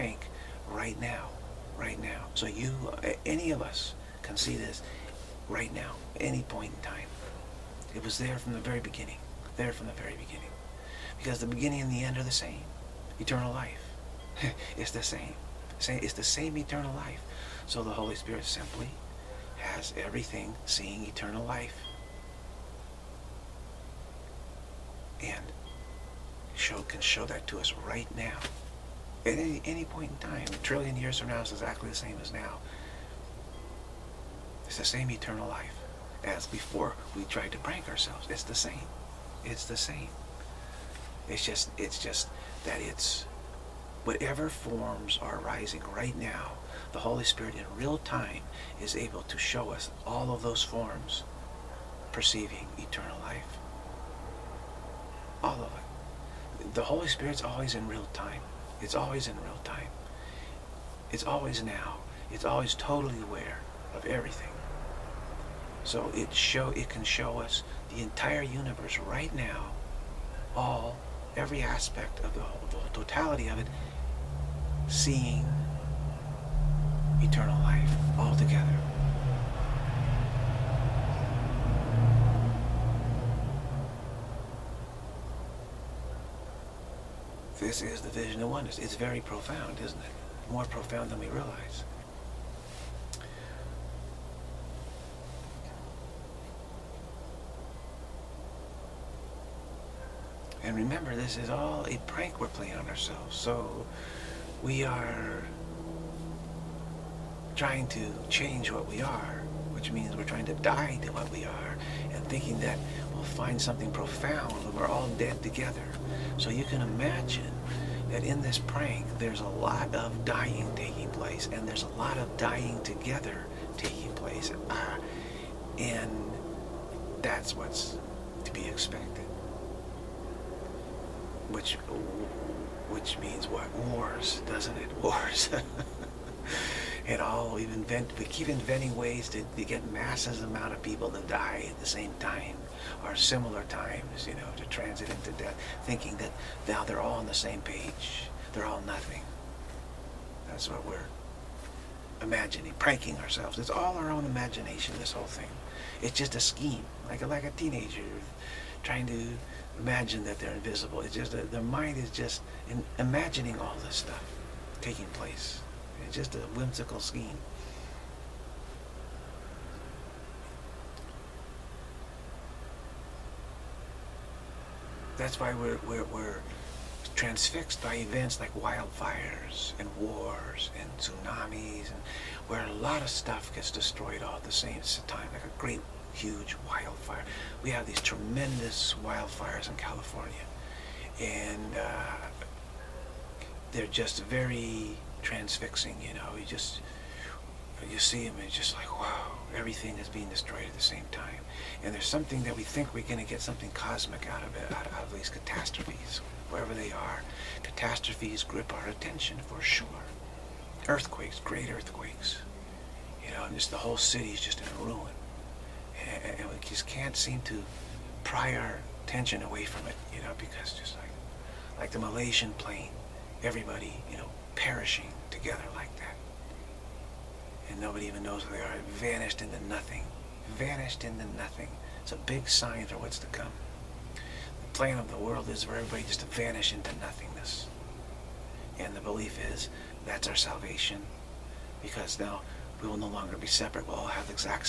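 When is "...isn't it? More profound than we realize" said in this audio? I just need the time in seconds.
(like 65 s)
89 s.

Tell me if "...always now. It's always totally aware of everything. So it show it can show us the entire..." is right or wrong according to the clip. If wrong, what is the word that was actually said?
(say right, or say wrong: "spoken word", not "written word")
right.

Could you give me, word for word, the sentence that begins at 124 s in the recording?
Uh, and that's what's to be expected which which means what wars, doesn't it?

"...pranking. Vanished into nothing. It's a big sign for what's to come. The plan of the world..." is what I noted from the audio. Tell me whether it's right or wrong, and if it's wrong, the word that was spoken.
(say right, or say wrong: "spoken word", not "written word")
wrong: "nothing", not "pranking".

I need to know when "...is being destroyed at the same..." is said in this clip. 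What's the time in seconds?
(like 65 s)
199 s.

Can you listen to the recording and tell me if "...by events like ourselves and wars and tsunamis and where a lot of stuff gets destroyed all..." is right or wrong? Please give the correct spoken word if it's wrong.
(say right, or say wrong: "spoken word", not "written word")
wrong: "wildfires", not "ourselves".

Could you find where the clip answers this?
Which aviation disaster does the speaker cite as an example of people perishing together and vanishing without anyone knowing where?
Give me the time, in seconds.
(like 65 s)
221 s.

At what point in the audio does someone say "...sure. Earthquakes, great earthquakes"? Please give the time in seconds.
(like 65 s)
209 s.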